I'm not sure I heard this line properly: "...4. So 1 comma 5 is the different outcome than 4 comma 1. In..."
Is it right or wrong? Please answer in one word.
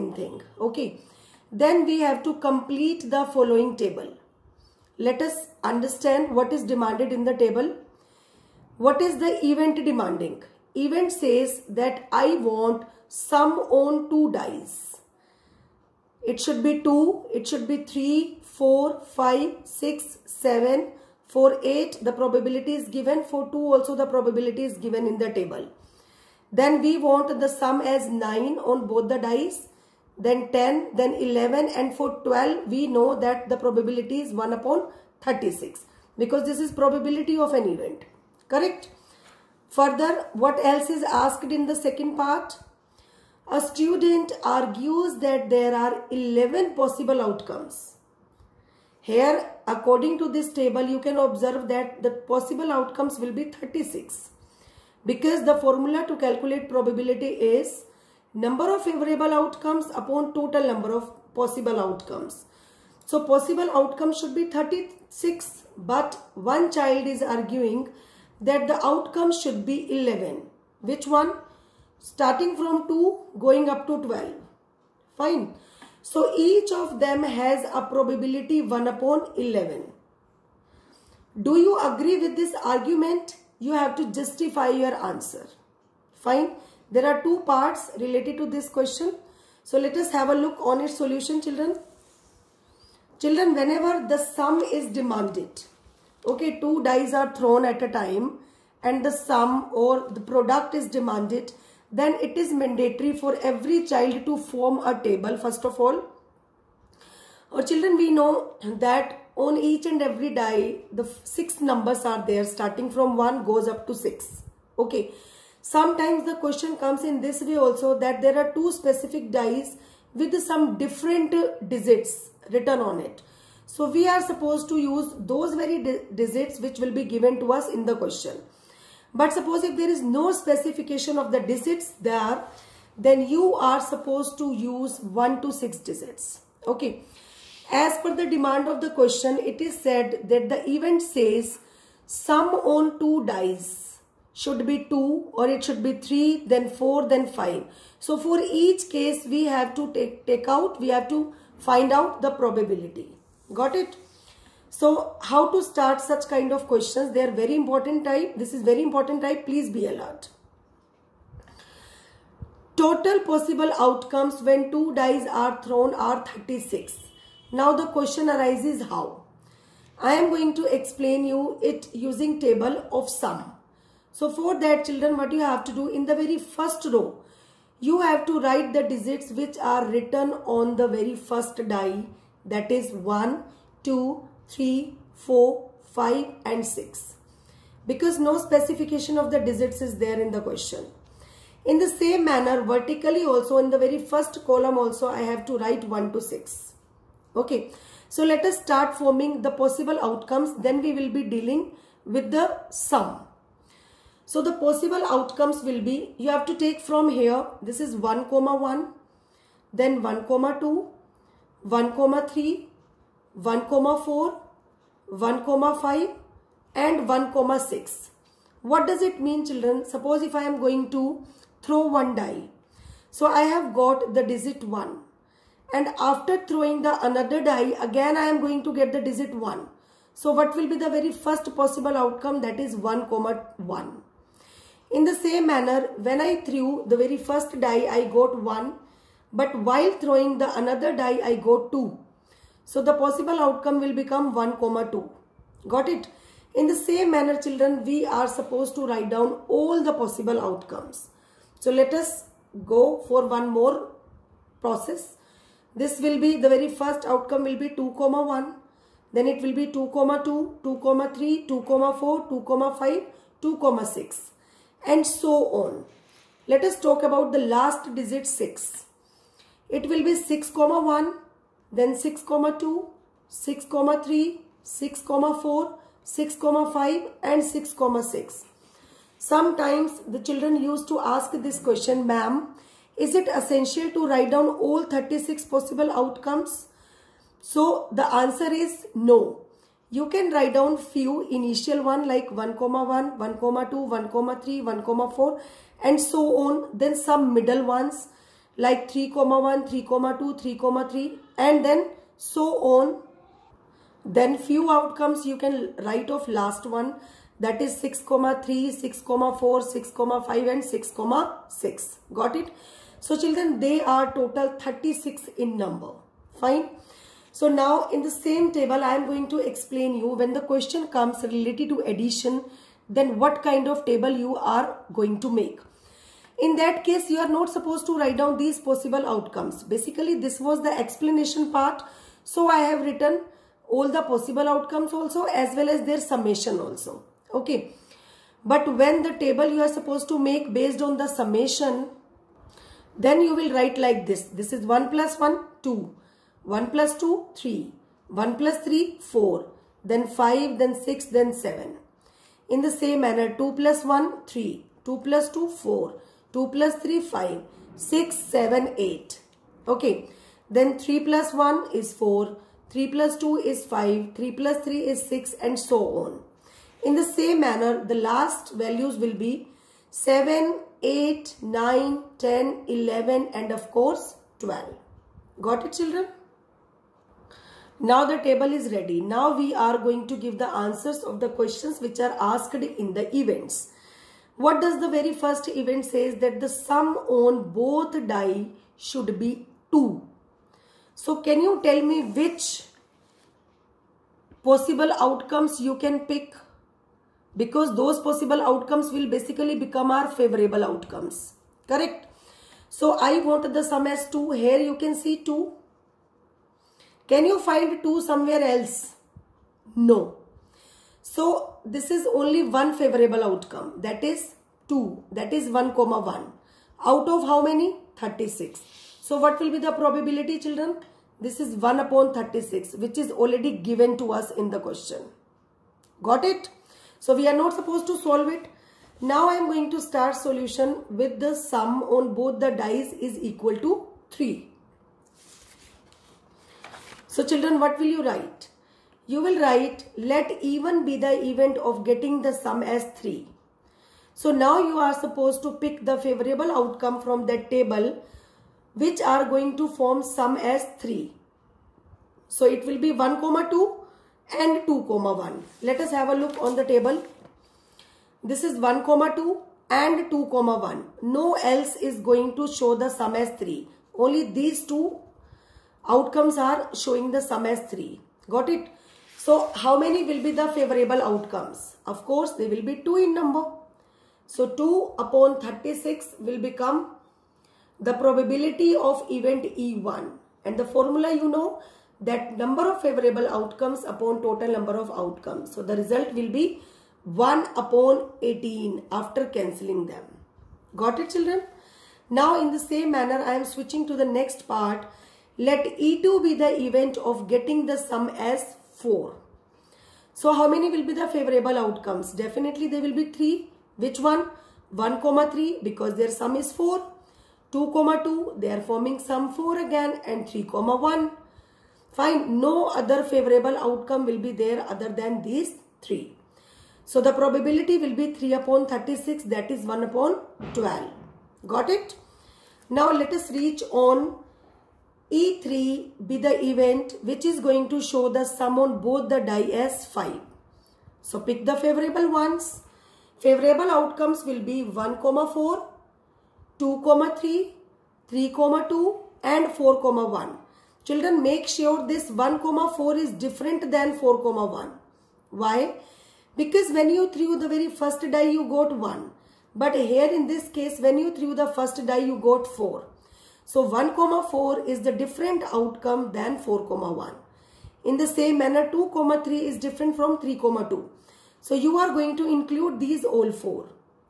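wrong.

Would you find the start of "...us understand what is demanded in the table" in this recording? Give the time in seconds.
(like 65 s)
5 s.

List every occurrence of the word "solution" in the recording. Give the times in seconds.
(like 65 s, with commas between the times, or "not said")
90 s, 430 s.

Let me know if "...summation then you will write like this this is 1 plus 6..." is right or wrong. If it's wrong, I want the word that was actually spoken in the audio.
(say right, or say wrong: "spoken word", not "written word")
wrong: "1", not "6".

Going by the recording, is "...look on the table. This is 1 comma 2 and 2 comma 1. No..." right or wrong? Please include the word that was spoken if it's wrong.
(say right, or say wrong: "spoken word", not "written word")
right.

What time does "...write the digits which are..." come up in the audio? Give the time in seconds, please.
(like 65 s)
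178 s.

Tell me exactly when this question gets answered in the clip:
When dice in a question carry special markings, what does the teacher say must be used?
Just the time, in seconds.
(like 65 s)
125 s.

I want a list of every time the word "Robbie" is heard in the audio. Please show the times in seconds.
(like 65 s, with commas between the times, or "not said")
not said.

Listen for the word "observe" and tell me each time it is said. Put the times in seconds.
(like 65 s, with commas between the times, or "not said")
51 s.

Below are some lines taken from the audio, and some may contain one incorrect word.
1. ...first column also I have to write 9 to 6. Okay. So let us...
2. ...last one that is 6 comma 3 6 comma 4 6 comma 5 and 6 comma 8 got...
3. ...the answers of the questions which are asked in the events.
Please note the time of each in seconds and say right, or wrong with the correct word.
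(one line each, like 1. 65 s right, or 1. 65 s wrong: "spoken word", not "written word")
1. 194 s wrong: "1", not "9"
2. 306 s wrong: "6", not "8"
3. 380 s right.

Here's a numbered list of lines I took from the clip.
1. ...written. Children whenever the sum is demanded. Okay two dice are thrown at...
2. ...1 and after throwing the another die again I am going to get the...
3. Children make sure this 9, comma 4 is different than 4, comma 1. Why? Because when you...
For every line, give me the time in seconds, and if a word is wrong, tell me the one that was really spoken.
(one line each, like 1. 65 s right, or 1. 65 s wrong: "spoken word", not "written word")
1. 91 s wrong: "children", not "written"
2. 224 s right
3. 540 s wrong: "1", not "9".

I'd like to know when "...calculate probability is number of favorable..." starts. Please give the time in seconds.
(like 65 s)
56 s.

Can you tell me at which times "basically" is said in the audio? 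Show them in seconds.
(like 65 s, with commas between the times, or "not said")
329 s, 399 s.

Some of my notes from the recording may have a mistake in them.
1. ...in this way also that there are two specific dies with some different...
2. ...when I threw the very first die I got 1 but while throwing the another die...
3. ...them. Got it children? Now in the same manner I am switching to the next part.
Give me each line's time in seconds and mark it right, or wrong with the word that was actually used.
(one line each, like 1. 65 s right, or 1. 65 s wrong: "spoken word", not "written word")
1. 117 s right
2. 235 s right
3. 489 s right.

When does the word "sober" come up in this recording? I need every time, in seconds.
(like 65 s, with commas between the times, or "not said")
not said.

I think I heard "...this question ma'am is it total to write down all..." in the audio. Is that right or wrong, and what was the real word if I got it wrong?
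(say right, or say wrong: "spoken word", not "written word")
wrong: "essential", not "total".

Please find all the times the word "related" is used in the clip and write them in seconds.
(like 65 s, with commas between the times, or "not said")
87 s, 321 s.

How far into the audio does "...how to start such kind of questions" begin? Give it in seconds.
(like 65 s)
155 s.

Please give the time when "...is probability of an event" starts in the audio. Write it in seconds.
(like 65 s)
36 s.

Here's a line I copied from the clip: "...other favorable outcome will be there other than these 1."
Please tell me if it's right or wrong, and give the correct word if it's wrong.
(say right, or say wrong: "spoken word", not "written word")
wrong: "3", not "1".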